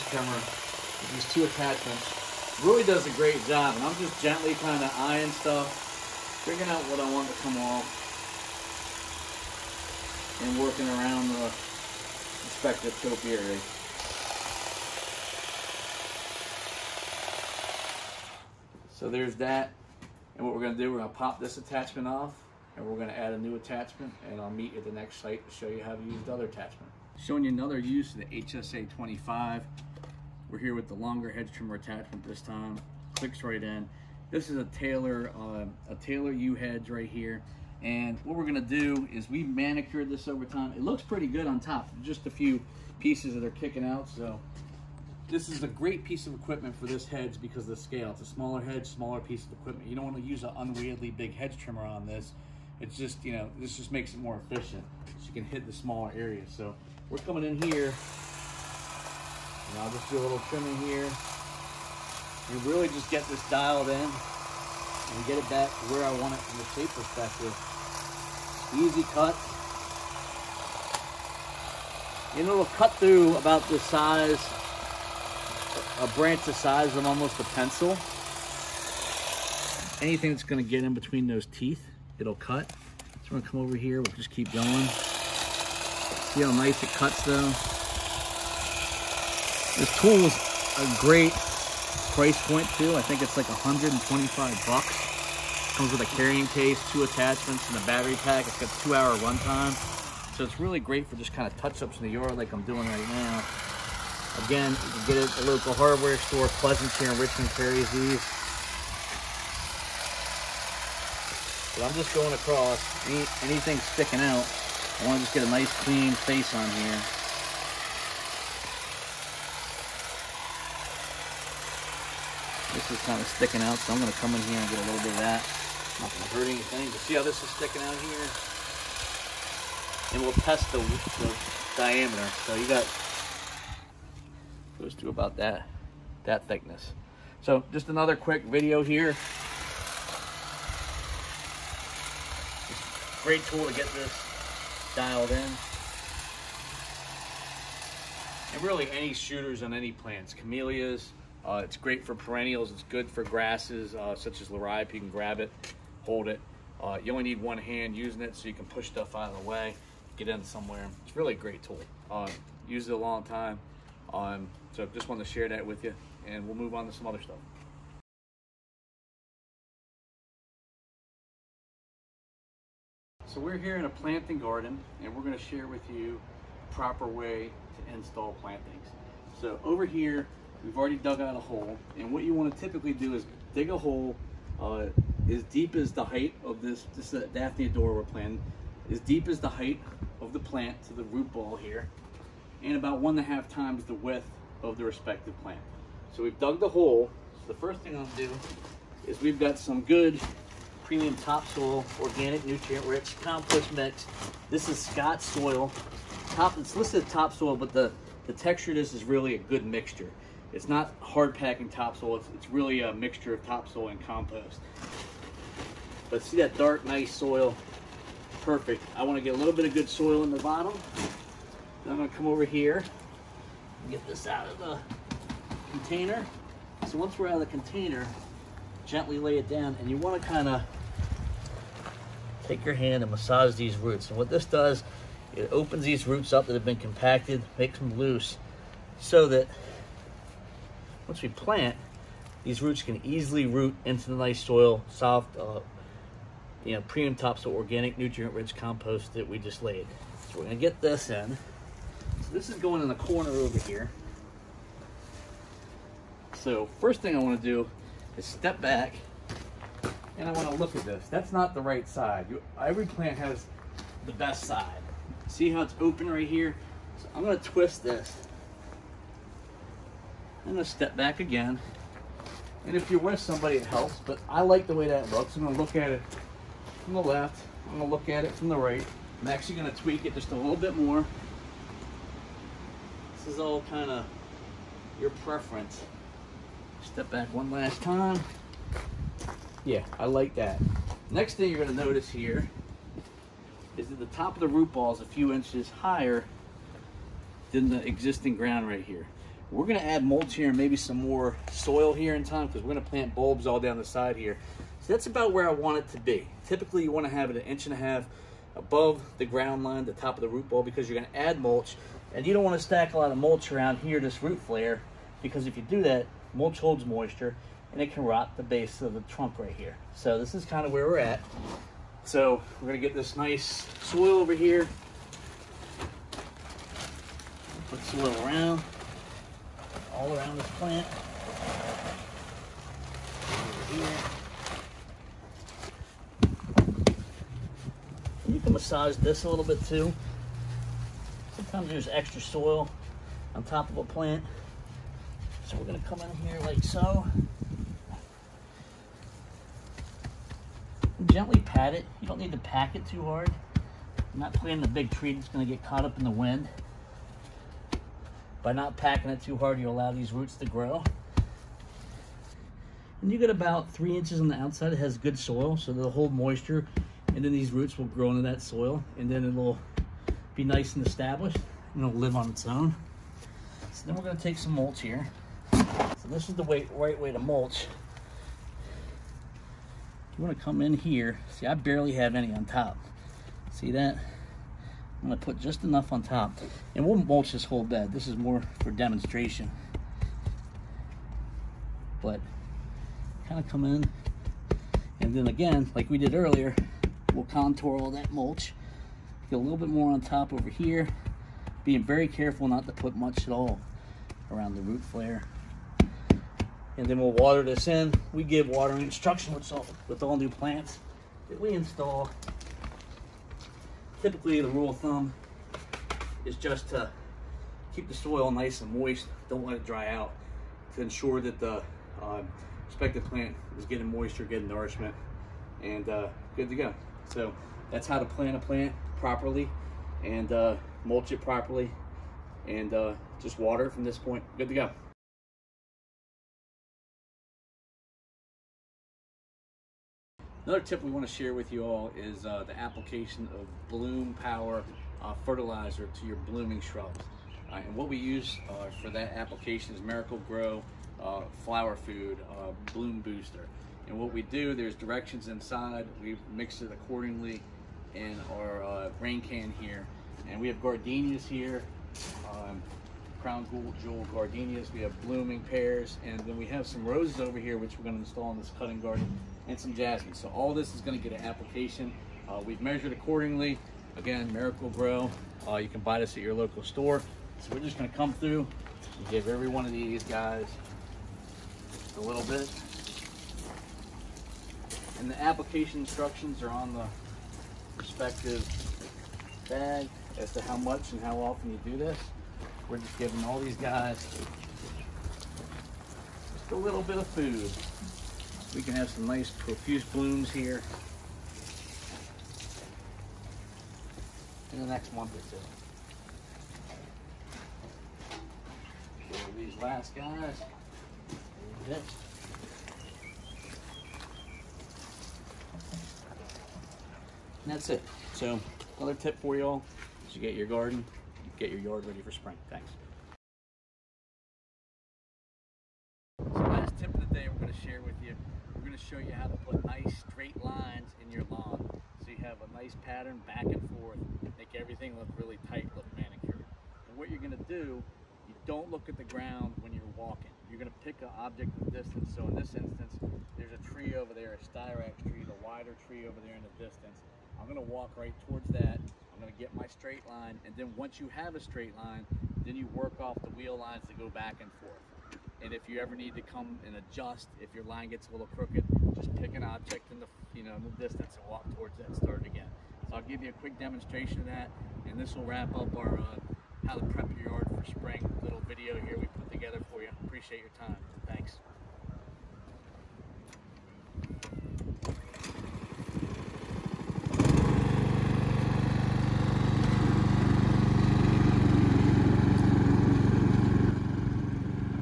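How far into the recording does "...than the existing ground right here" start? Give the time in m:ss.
4:57.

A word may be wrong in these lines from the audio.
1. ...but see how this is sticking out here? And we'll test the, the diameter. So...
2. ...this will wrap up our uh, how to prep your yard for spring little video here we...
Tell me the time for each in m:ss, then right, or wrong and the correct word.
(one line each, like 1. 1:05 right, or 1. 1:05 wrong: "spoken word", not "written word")
1. 2:06 right
2. 9:24 right.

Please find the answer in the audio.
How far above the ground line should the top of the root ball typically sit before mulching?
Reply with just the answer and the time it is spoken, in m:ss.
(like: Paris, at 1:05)
1.5 inches, at 5:07.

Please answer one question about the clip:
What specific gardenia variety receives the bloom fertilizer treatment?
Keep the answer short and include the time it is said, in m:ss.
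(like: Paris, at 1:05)
crown jewel, at 7:43.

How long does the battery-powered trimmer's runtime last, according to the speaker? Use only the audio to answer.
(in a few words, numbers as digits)
2 hours.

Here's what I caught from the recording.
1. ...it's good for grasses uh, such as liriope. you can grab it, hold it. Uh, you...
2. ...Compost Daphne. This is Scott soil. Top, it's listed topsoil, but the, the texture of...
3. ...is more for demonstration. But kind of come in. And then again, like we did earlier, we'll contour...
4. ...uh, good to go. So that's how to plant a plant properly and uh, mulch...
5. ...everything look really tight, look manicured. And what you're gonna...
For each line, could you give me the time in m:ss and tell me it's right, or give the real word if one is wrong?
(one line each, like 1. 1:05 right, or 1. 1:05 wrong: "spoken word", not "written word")
1. 2:32 right
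2. 3:23 wrong: "Mix", not "Daphne"
3. 6:28 right
4. 7:05 right
5. 8:54 right.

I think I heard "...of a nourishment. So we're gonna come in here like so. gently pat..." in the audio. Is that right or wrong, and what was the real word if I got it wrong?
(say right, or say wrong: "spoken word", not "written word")
wrong: "plant", not "nourishment".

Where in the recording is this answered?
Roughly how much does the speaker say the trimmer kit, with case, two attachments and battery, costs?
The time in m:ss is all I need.
1:33.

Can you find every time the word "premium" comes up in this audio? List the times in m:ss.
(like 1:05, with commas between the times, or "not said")
3:20, 4:06.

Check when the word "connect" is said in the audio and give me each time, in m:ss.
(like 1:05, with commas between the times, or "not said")
not said.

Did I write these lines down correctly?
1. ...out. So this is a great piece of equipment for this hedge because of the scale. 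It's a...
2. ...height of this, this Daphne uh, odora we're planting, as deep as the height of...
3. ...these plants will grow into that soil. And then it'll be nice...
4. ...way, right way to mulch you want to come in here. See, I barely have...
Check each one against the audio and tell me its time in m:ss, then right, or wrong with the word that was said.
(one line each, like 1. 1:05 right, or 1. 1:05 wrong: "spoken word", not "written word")
1. 0:43 right
2. 3:06 right
3. 6:07 wrong: "roots", not "plants"
4. 6:16 right.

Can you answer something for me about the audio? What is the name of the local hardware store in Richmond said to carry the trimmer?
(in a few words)
Pleasant.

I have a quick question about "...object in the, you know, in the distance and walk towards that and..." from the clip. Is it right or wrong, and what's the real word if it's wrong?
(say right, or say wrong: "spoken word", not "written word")
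right.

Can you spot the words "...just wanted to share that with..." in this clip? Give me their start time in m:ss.
2:44.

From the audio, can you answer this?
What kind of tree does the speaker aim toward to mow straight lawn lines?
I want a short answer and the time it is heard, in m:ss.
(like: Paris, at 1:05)
styrax, at 9:04.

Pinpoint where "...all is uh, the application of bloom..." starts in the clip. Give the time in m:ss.
7:21.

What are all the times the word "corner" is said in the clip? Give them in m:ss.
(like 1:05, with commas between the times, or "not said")
4:12.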